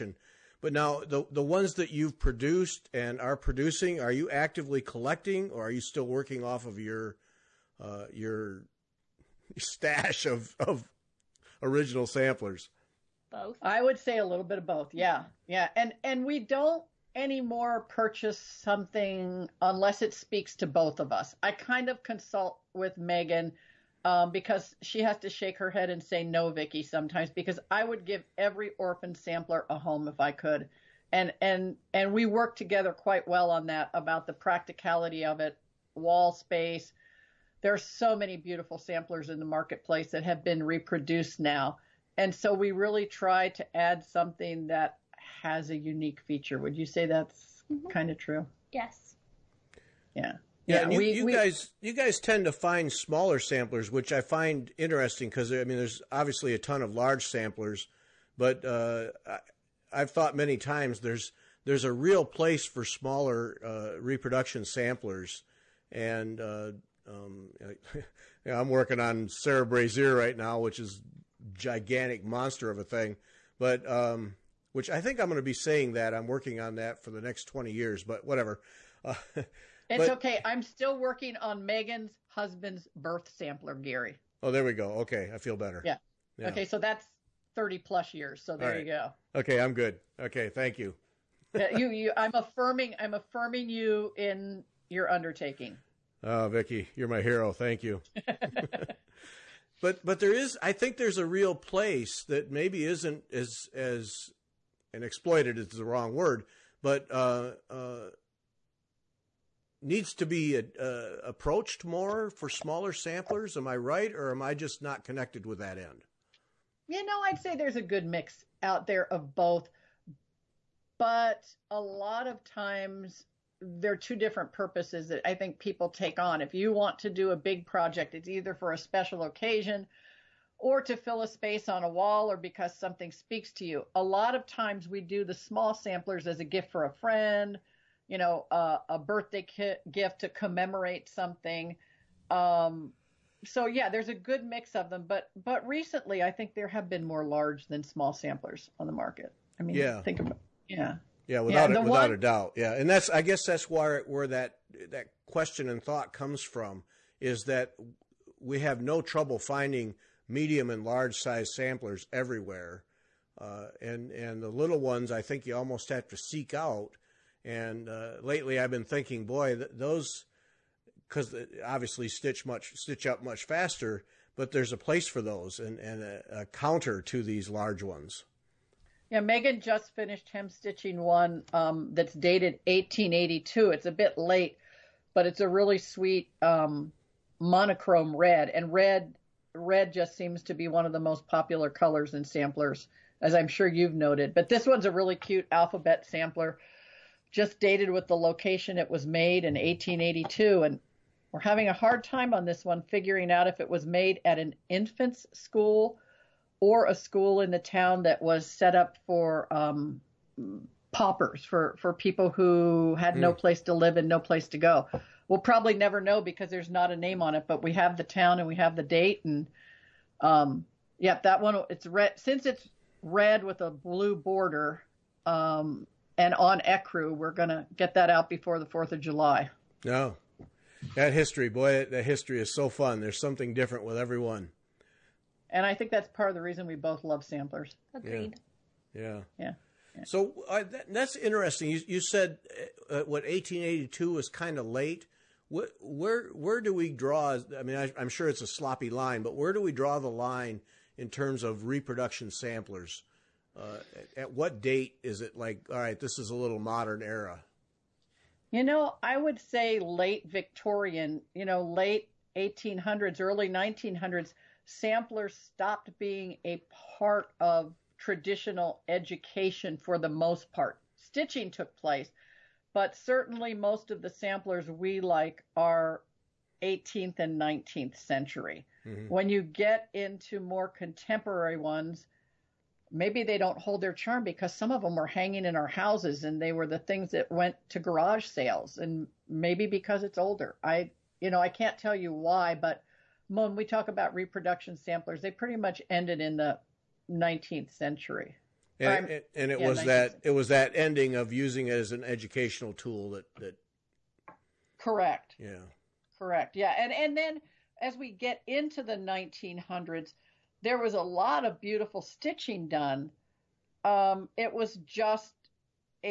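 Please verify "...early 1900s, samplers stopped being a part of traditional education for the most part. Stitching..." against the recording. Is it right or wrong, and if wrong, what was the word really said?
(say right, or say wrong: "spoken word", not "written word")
right.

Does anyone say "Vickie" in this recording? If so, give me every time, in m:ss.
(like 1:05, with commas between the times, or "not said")
0:26, 1:36.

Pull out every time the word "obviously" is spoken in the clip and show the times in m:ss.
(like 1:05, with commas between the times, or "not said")
0:56, 2:51.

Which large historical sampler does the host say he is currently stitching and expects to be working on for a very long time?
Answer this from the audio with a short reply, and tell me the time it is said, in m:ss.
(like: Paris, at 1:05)
Sarah Brazier, at 1:09.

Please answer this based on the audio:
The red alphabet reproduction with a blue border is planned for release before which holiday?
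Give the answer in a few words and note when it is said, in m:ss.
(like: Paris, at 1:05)
4th of July, at 3:48.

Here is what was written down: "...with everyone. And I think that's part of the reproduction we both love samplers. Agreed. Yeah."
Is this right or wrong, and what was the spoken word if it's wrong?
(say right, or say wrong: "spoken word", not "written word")
wrong: "reason", not "reproduction".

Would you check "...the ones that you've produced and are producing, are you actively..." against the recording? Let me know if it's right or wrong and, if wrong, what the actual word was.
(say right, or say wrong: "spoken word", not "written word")
right.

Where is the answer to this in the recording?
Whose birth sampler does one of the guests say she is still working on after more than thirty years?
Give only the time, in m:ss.
1:23.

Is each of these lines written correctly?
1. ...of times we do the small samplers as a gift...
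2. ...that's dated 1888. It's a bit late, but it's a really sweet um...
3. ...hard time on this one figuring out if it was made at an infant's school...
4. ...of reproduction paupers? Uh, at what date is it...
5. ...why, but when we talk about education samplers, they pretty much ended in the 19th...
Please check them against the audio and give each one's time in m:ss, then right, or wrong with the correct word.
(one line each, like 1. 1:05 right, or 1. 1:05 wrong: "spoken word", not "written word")
1. 2:14 right
2. 3:01 wrong: "1882", not "1888"
3. 3:21 right
4. 4:11 wrong: "samplers", not "paupers"
5. 4:52 wrong: "reproduction", not "education".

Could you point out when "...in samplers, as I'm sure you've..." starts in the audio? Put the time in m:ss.
3:12.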